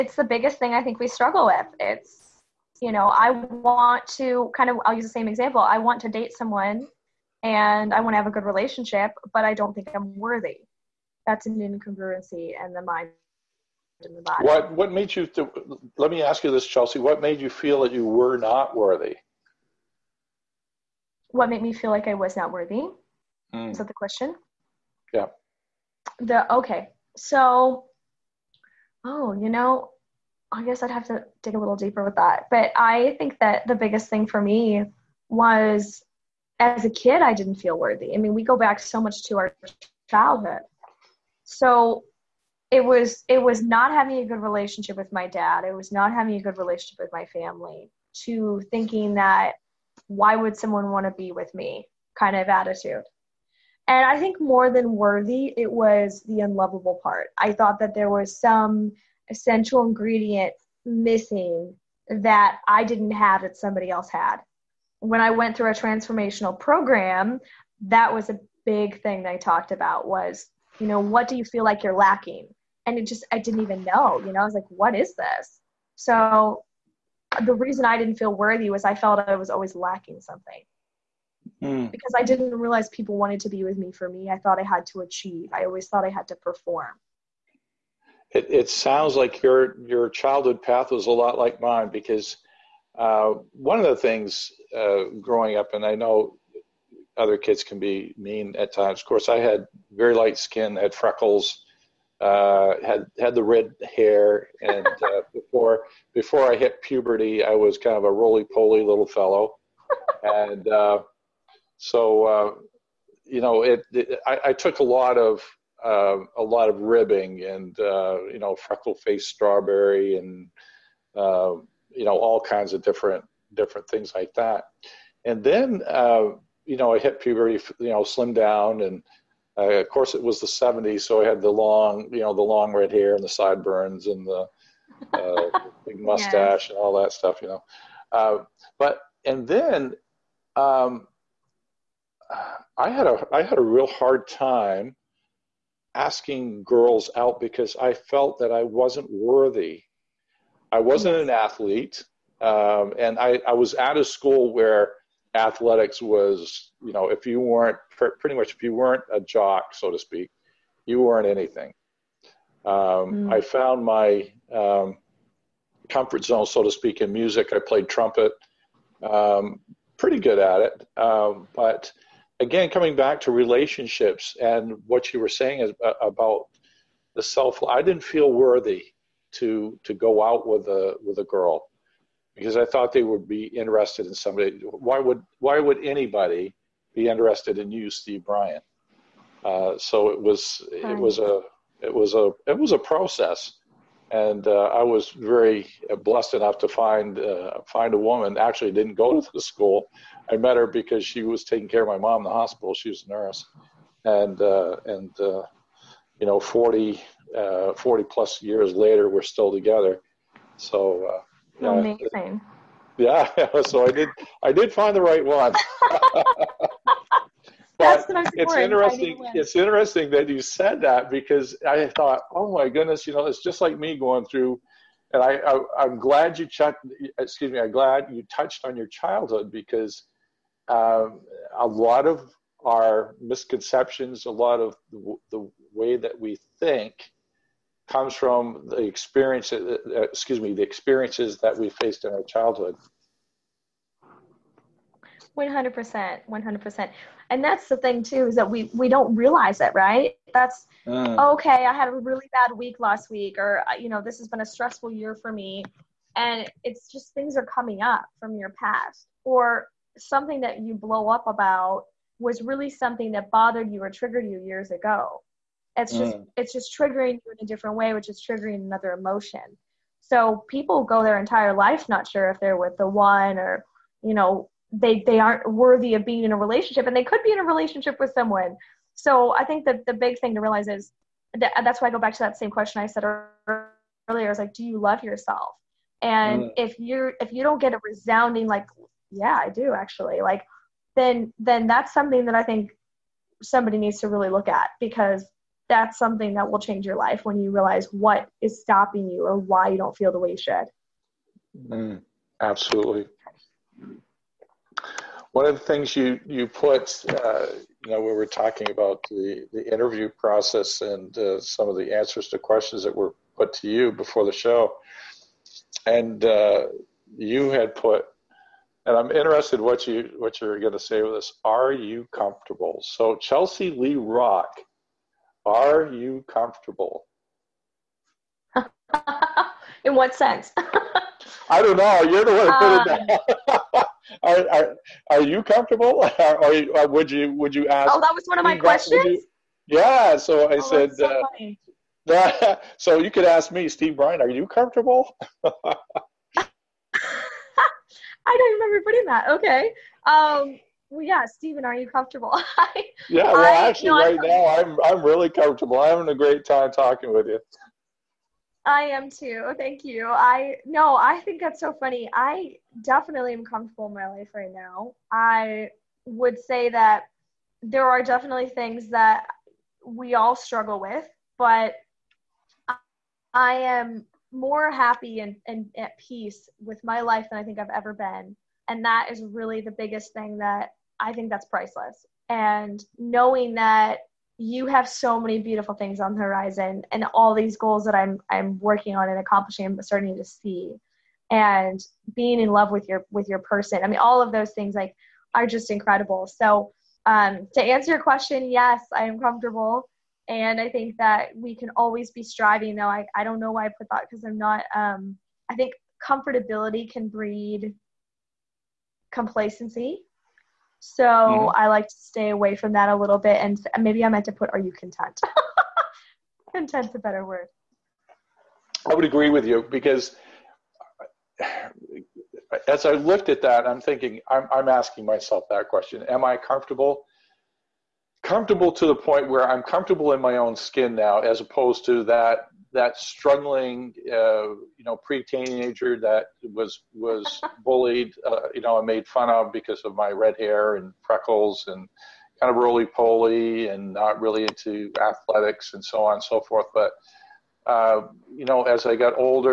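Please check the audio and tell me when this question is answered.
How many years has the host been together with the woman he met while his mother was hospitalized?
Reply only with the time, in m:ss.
3:27.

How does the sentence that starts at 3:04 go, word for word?
Why would why would anybody be interested in you, Steve Bryan?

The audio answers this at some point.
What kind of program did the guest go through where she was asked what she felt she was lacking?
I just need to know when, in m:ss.
1:05.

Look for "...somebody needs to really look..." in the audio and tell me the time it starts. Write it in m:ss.
4:53.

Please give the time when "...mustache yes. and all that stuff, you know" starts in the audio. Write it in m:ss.
2:15.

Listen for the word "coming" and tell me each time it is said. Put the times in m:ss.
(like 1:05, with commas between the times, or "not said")
2:52, 4:17.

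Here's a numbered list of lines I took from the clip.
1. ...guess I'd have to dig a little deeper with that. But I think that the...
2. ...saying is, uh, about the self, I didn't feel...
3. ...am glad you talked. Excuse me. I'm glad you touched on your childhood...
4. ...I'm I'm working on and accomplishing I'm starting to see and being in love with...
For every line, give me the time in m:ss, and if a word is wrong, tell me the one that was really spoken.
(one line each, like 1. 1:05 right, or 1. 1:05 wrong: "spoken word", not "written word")
1. 0:30 right
2. 2:55 right
3. 3:45 wrong: "checked", not "talked"
4. 6:27 right.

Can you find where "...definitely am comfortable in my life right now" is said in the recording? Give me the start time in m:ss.
6:02.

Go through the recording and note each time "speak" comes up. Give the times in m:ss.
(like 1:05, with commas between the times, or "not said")
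2:39, 2:46.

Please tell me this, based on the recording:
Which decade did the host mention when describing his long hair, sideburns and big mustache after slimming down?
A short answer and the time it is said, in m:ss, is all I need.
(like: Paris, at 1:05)
The '70s, at 2:10.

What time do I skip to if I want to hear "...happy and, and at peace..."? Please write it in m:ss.
6:14.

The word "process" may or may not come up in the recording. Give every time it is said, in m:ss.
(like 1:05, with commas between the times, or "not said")
3:12, 5:10.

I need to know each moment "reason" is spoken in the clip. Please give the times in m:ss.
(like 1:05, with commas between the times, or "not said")
1:17.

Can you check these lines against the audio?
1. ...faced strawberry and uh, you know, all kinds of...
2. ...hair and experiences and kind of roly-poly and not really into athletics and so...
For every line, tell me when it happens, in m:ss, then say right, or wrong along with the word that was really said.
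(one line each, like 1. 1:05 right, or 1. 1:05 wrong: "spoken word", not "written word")
1. 1:58 right
2. 7:20 wrong: "freckles", not "experiences".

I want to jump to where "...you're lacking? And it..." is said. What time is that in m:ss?
1:11.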